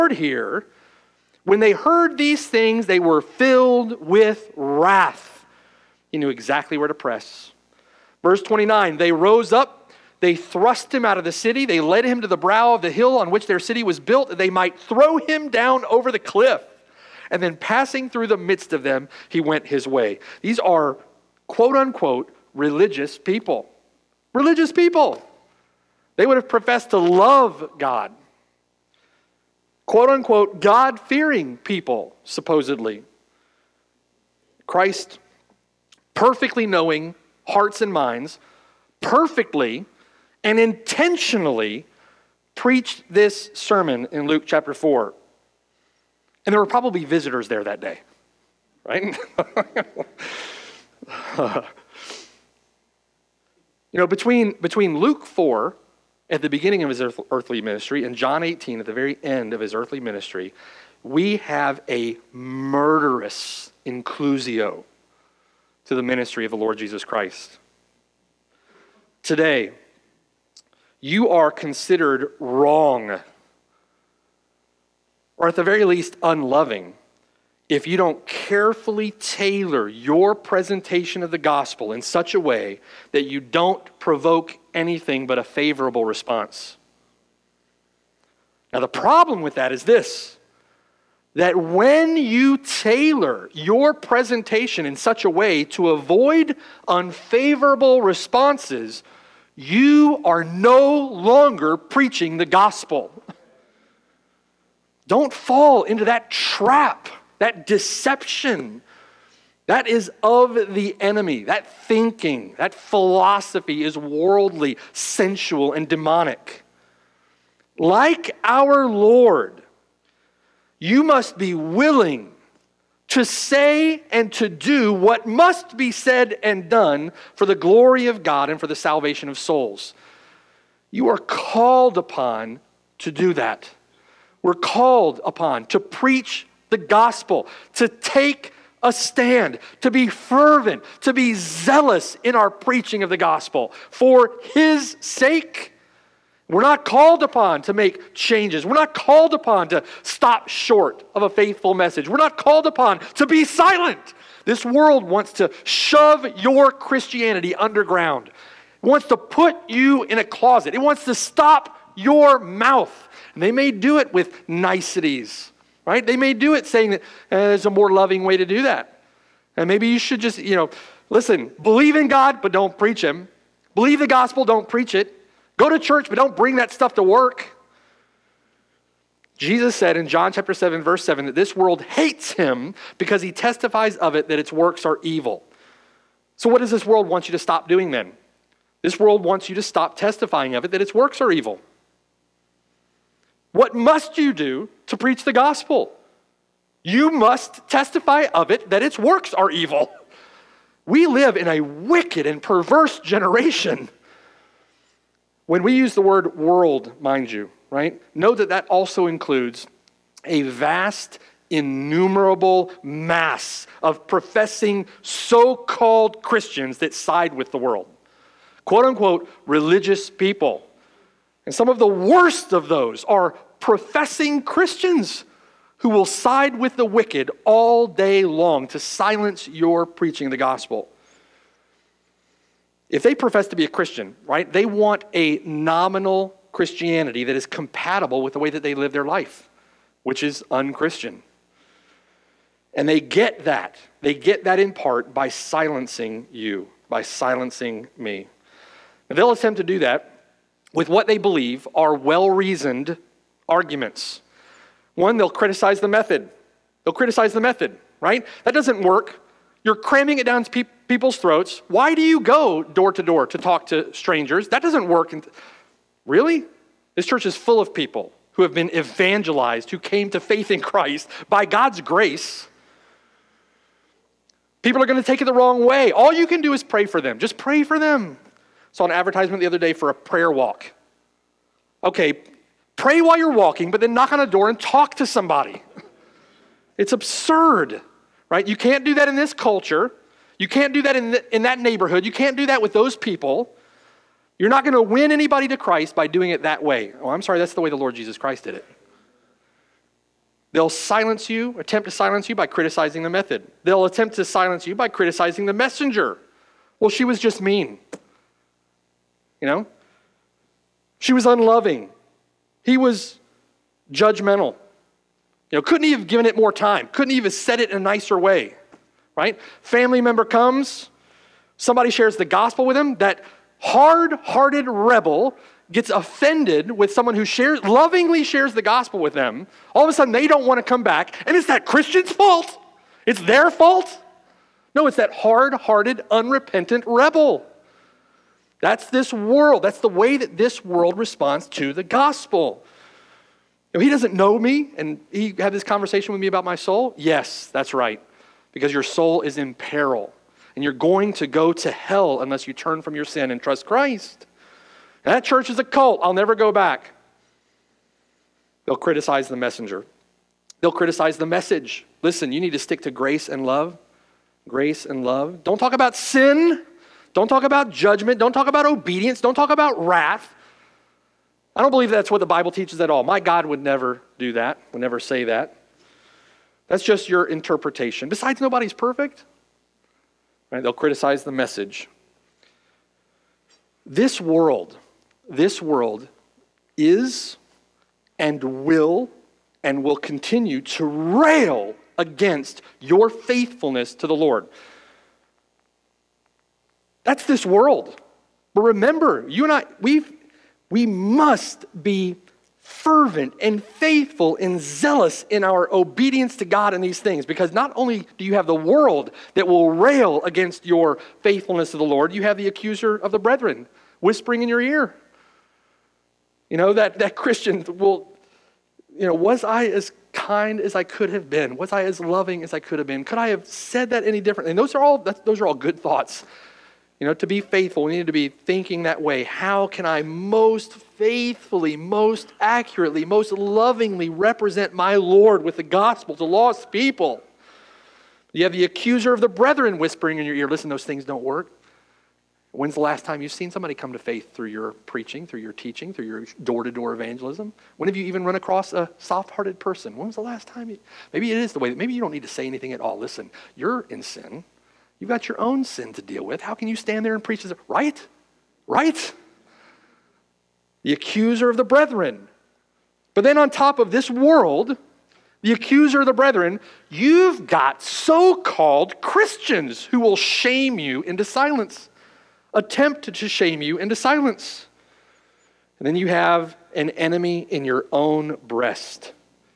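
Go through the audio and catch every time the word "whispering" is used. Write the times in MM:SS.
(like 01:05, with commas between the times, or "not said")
06:54, 07:19.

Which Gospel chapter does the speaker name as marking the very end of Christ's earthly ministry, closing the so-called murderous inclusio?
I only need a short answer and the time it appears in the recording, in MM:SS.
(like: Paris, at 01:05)
John 18, at 00:58.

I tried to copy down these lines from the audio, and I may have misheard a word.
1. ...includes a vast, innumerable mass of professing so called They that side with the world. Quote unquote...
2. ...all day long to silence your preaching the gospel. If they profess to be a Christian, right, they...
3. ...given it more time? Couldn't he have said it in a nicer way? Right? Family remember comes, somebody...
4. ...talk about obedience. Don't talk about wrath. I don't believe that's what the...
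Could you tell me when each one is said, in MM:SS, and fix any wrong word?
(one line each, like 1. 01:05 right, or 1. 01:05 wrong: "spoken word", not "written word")
1. 03:29 wrong: "Christians", not "They"
2. 03:47 right
3. 05:16 wrong: "member", not "remember"
4. 06:08 right.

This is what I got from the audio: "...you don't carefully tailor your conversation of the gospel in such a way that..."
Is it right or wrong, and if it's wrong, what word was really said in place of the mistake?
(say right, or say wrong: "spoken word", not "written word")
wrong: "presentation", not "conversation".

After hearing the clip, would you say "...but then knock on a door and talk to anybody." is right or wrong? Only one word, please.
wrong.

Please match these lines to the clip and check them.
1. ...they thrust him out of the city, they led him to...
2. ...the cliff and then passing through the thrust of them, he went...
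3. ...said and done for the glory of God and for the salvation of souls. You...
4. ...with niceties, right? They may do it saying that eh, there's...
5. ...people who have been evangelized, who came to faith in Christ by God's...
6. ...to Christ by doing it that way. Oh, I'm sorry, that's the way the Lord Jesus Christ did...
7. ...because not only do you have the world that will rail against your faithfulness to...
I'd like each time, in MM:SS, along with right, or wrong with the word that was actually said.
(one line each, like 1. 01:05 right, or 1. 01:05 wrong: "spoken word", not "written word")
1. 00:10 right
2. 00:16 wrong: "midst", not "thrust"
3. 02:05 right
4. 02:44 right
5. 04:27 right
6. 04:55 right
7. 06:47 right.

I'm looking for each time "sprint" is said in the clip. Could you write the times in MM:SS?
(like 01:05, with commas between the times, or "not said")
not said.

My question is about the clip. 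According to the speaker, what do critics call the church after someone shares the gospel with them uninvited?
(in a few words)
A cult.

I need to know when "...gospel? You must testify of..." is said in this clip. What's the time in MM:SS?
03:15.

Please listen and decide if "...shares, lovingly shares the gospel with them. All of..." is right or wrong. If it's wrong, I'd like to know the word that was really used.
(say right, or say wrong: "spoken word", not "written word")
right.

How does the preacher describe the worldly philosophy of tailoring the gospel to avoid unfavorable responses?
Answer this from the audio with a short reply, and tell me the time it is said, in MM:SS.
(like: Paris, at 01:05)
worldly, sensual, and demonic, at 01:53.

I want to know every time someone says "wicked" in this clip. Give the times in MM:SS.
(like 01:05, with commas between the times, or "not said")
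03:21, 03:46.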